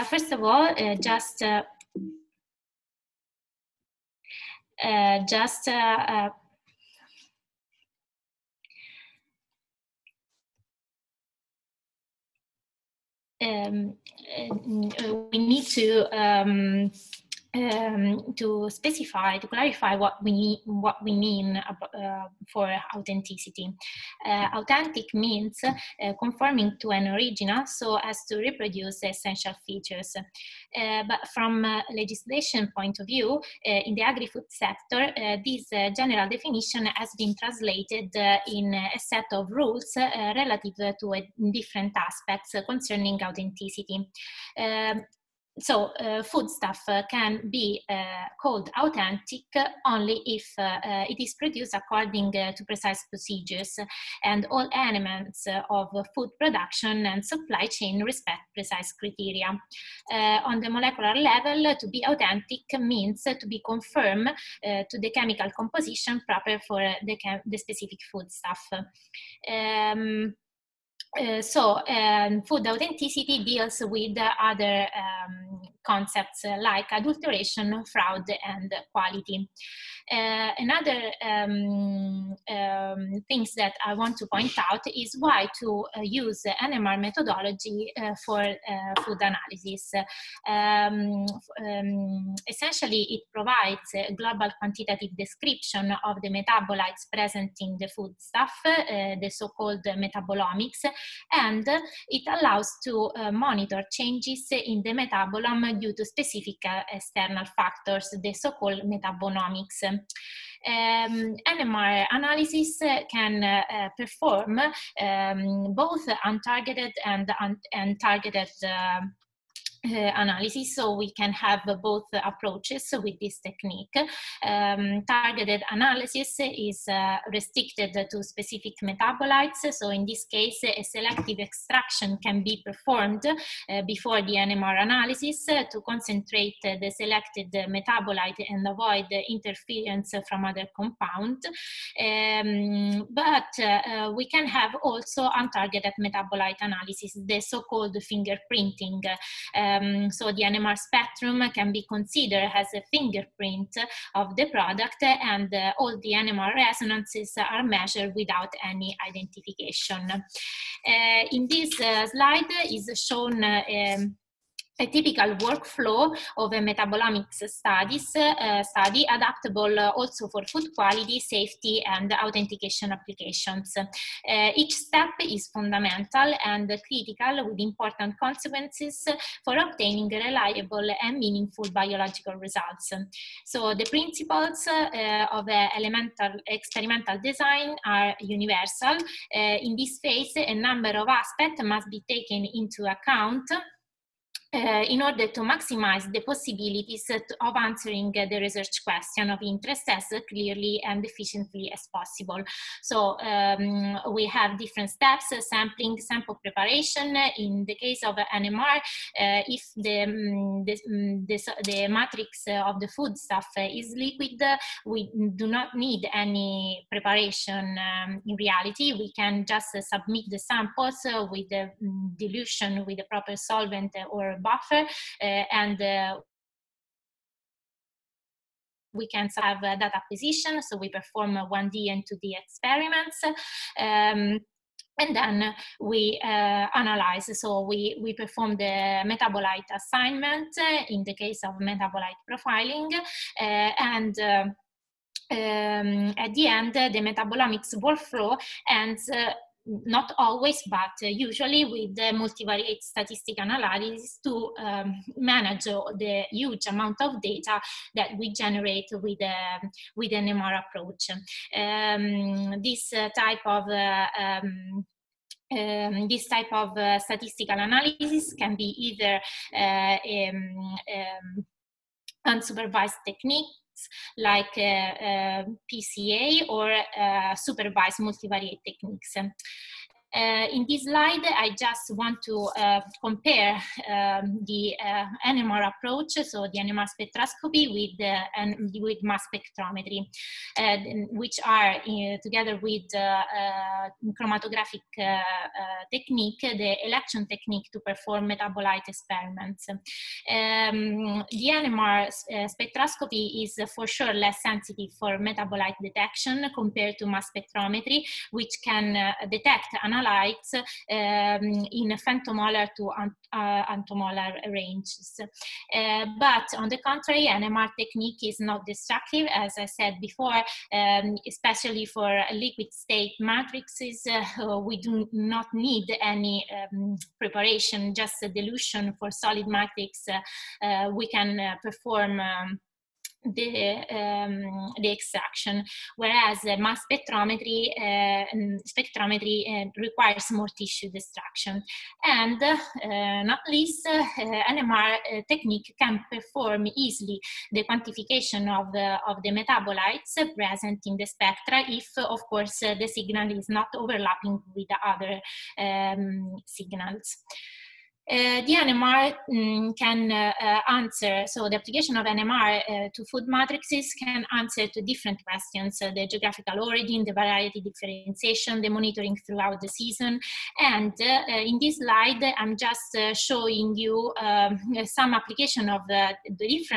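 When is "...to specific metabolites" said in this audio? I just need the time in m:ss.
2:08.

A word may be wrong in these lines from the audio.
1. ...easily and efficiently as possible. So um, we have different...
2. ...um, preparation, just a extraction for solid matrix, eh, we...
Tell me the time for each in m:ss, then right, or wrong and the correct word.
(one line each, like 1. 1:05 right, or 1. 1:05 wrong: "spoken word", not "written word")
1. 3:20 wrong: "clearly", not "easily"
2. 5:26 wrong: "dilution", not "extraction".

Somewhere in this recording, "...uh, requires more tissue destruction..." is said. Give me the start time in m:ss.
5:39.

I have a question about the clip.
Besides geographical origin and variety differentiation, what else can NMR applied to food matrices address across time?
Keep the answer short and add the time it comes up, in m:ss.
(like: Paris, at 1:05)
monitoring throughout the season, at 6:08.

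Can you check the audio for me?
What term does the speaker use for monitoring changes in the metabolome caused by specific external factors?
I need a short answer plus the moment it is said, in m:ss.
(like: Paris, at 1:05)
metabonomics, at 1:48.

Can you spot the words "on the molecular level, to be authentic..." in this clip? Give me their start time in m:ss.
1:00.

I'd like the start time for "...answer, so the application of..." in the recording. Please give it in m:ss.
6:00.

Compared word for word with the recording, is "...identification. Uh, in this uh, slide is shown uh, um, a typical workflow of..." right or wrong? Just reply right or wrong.
right.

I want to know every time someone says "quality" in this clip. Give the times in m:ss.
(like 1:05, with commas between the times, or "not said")
1:18, 2:50.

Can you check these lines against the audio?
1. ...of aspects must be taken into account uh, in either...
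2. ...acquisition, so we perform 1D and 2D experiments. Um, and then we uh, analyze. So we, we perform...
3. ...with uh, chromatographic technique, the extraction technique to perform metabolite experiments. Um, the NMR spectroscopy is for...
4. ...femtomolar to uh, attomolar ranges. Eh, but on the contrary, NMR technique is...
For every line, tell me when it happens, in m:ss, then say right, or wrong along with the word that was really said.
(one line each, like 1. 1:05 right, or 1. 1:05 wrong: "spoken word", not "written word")
1. 3:10 wrong: "order", not "either"
2. 3:49 right
3. 4:52 wrong: "election", not "extraction"
4. 5:11 right.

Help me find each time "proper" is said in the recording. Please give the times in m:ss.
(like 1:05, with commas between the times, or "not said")
1:06, 3:43.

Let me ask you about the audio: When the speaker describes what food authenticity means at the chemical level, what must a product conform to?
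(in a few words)
chemical composition.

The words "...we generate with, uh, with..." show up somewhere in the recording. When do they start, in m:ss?
4:18.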